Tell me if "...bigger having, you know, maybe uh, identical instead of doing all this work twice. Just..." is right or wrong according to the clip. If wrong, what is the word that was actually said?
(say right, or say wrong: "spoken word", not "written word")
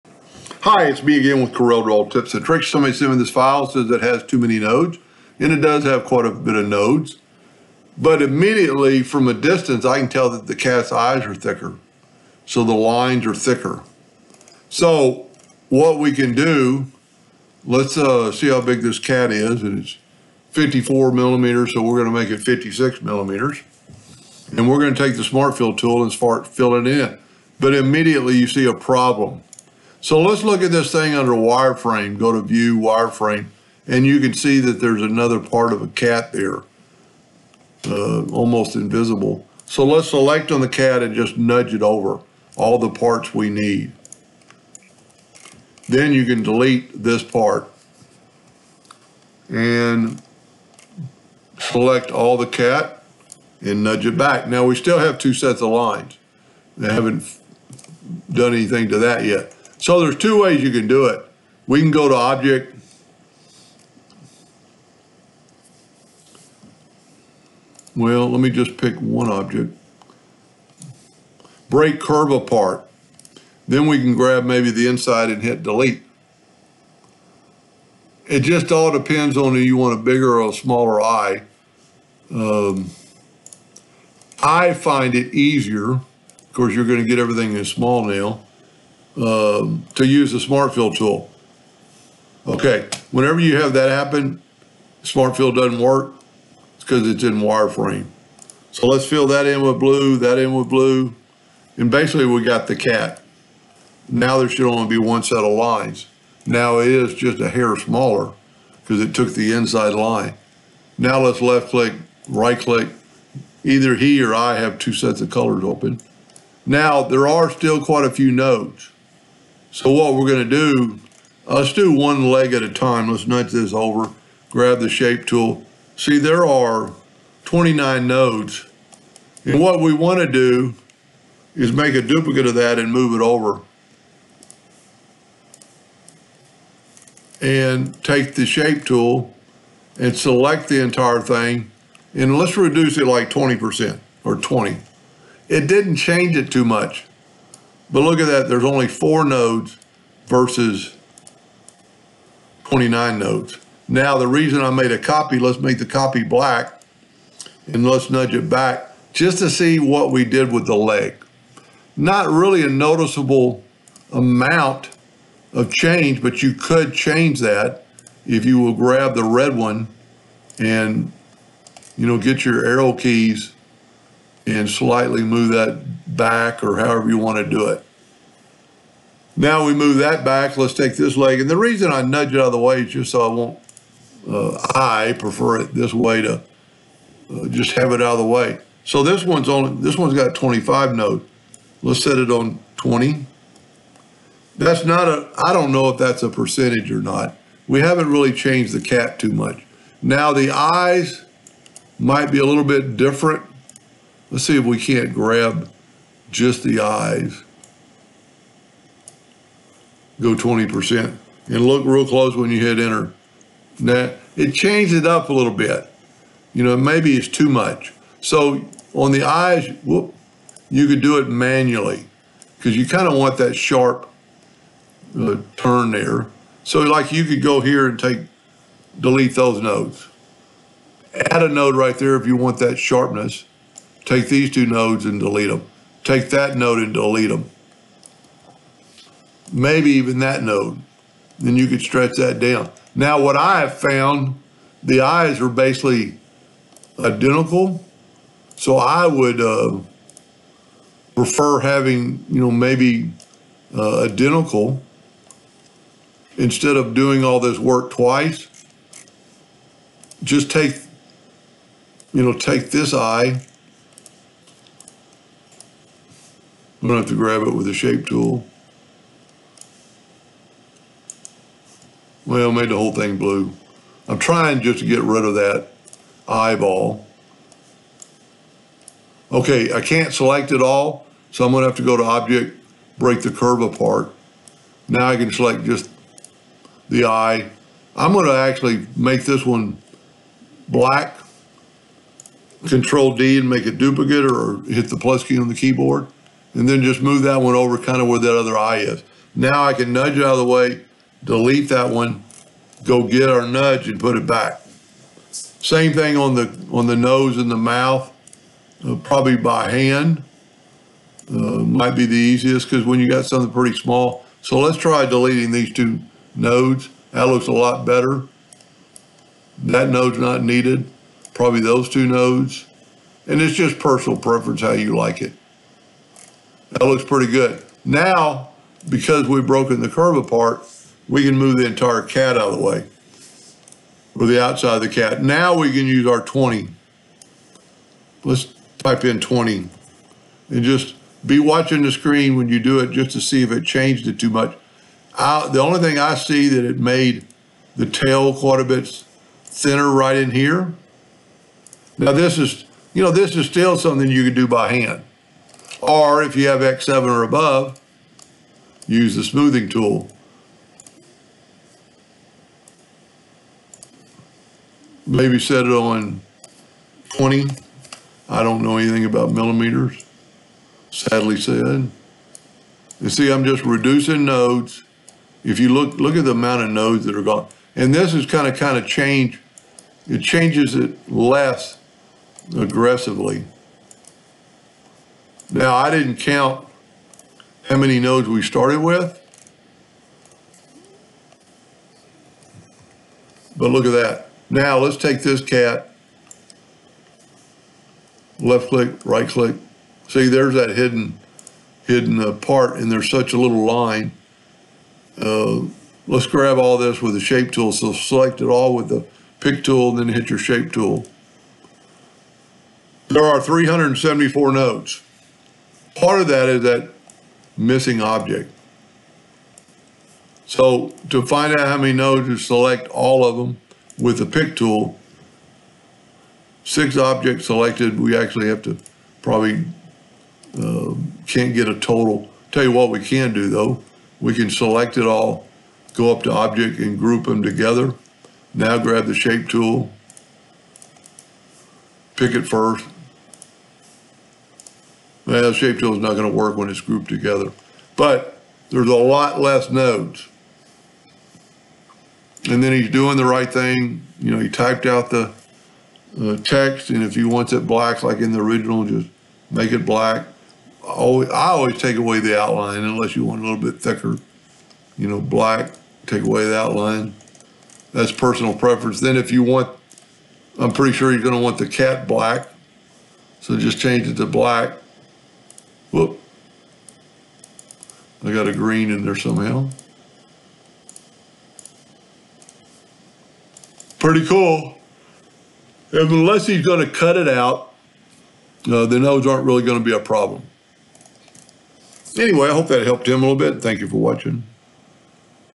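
wrong: "prefer", not "bigger".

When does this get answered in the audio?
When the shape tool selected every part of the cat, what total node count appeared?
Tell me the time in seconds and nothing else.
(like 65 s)
413 s.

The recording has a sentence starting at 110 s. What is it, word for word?
Now let's left click, right click.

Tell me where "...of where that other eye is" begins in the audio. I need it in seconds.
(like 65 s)
298 s.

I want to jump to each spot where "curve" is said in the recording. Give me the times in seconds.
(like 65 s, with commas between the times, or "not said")
71 s, 283 s, 329 s.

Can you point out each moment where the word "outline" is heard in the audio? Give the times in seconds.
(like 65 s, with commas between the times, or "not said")
462 s, 466 s.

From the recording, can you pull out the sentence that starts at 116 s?
Now there are still quite a few nodes.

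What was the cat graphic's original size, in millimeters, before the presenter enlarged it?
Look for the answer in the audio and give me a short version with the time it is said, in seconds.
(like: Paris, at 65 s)
54 millimeters, at 20 s.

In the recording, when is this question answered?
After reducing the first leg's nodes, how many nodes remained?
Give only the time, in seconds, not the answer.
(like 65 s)
148 s.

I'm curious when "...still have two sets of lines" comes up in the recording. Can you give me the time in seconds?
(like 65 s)
54 s.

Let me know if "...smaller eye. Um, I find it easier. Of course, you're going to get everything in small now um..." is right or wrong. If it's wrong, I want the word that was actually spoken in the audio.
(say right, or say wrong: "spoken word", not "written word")
right.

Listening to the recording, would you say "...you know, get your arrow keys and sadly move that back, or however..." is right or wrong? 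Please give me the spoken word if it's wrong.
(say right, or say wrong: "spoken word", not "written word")
wrong: "slightly", not "sadly".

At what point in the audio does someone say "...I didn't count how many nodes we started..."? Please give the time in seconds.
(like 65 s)
385 s.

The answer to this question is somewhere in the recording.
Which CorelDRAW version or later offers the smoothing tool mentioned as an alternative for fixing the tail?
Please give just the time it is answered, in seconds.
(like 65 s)
356 s.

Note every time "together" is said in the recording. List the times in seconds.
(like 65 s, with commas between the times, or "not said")
437 s, 447 s.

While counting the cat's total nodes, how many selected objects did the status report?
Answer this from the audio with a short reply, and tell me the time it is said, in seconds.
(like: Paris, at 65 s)
6, at 426 s.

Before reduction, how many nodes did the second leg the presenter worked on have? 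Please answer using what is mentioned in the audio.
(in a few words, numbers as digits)
25.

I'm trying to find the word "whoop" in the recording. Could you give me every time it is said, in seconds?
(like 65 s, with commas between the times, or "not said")
219 s, 475 s.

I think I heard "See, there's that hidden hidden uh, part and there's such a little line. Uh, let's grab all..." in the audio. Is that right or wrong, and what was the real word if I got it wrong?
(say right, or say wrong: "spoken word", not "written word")
right.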